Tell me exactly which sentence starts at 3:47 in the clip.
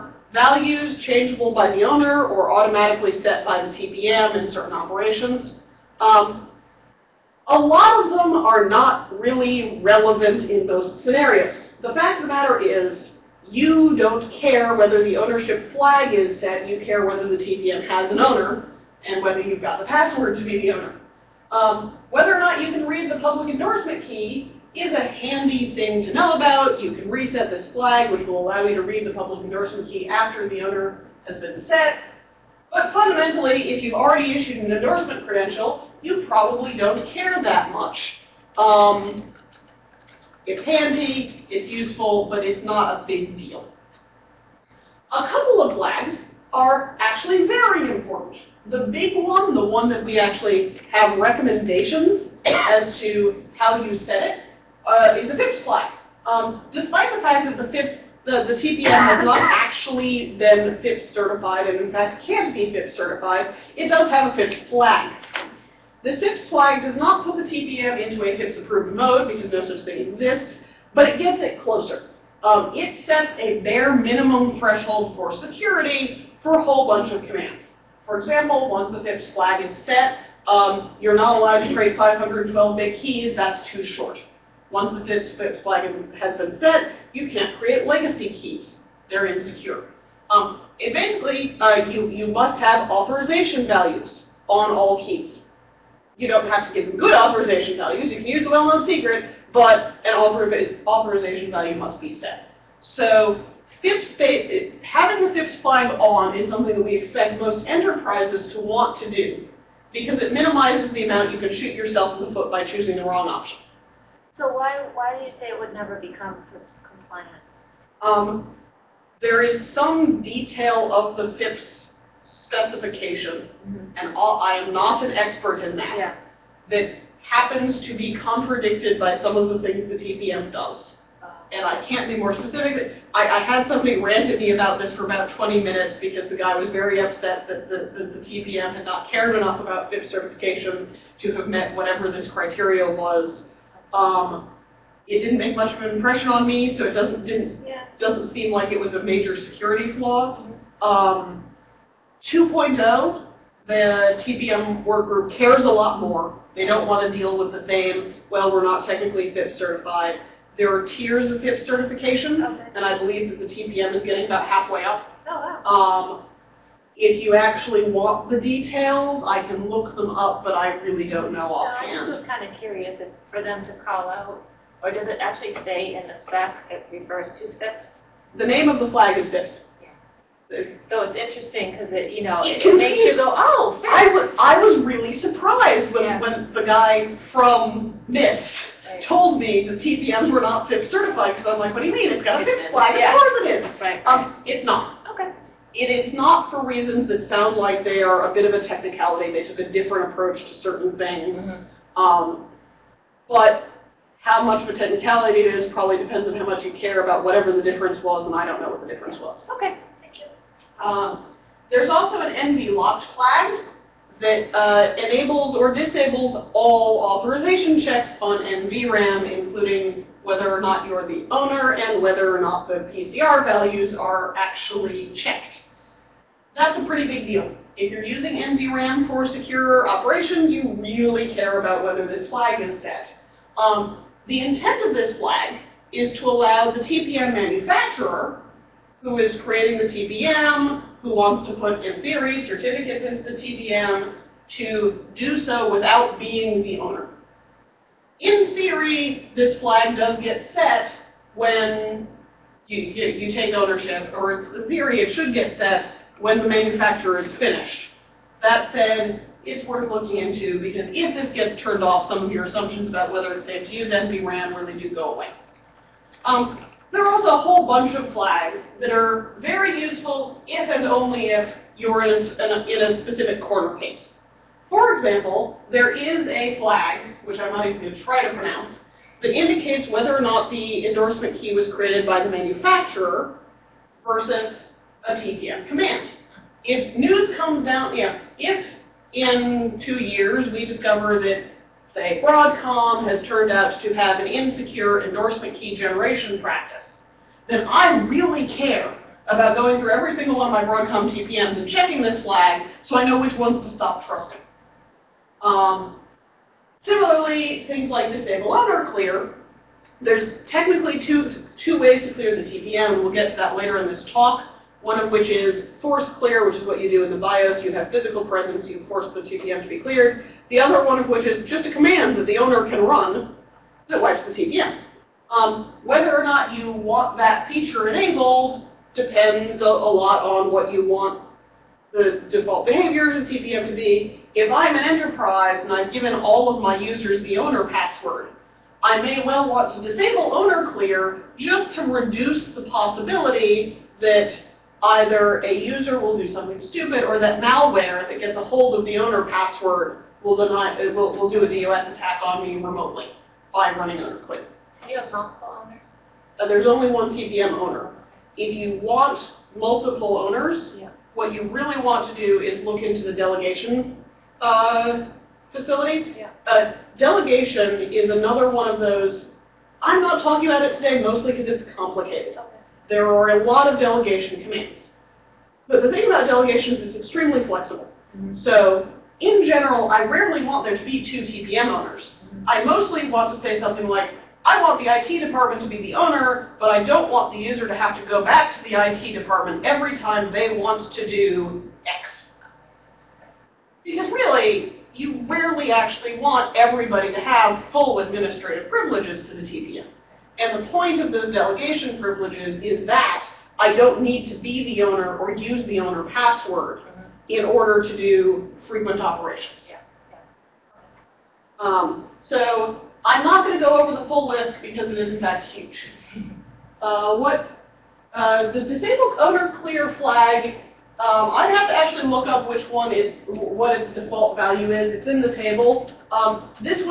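If you're using NVRAM for secure operations, you really care about whether this flag is set.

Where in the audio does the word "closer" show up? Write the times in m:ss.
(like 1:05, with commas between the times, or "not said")
1:11.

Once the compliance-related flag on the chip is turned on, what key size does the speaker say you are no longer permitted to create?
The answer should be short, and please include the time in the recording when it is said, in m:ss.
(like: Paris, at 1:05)
512-bit, at 1:21.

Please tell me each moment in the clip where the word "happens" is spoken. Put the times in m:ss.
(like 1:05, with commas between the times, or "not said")
2:07.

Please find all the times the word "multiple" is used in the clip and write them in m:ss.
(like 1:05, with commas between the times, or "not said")
5:55, 5:59.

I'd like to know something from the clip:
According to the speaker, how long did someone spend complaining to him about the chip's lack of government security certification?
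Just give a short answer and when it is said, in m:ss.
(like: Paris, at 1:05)
20 minutes, at 2:15.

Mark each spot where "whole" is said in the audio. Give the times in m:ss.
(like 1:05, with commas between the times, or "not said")
1:16, 4:27.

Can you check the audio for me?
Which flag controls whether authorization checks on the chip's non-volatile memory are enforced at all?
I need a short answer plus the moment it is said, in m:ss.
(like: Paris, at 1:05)
NV locked, at 3:32.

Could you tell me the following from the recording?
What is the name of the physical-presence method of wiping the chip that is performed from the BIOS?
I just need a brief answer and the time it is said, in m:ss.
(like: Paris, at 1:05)
force clear, at 5:15.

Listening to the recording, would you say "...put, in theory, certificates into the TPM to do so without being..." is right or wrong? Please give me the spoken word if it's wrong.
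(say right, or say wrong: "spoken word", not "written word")
right.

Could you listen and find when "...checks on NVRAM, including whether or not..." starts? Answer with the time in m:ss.
3:37.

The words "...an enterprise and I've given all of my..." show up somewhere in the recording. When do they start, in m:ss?
5:34.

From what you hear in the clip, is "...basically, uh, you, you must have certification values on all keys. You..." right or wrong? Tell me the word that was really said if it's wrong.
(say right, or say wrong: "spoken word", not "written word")
wrong: "authorization", not "certification".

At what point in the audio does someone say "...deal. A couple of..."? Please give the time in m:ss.
0:43.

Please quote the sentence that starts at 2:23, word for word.
Um, it didn't make much of an impression on me, so it doesn't didn't yeah.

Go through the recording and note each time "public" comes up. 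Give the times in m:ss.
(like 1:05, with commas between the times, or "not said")
0:23, 0:29.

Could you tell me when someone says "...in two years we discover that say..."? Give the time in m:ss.
4:49.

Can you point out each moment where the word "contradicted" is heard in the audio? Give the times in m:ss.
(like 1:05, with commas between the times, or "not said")
2:08.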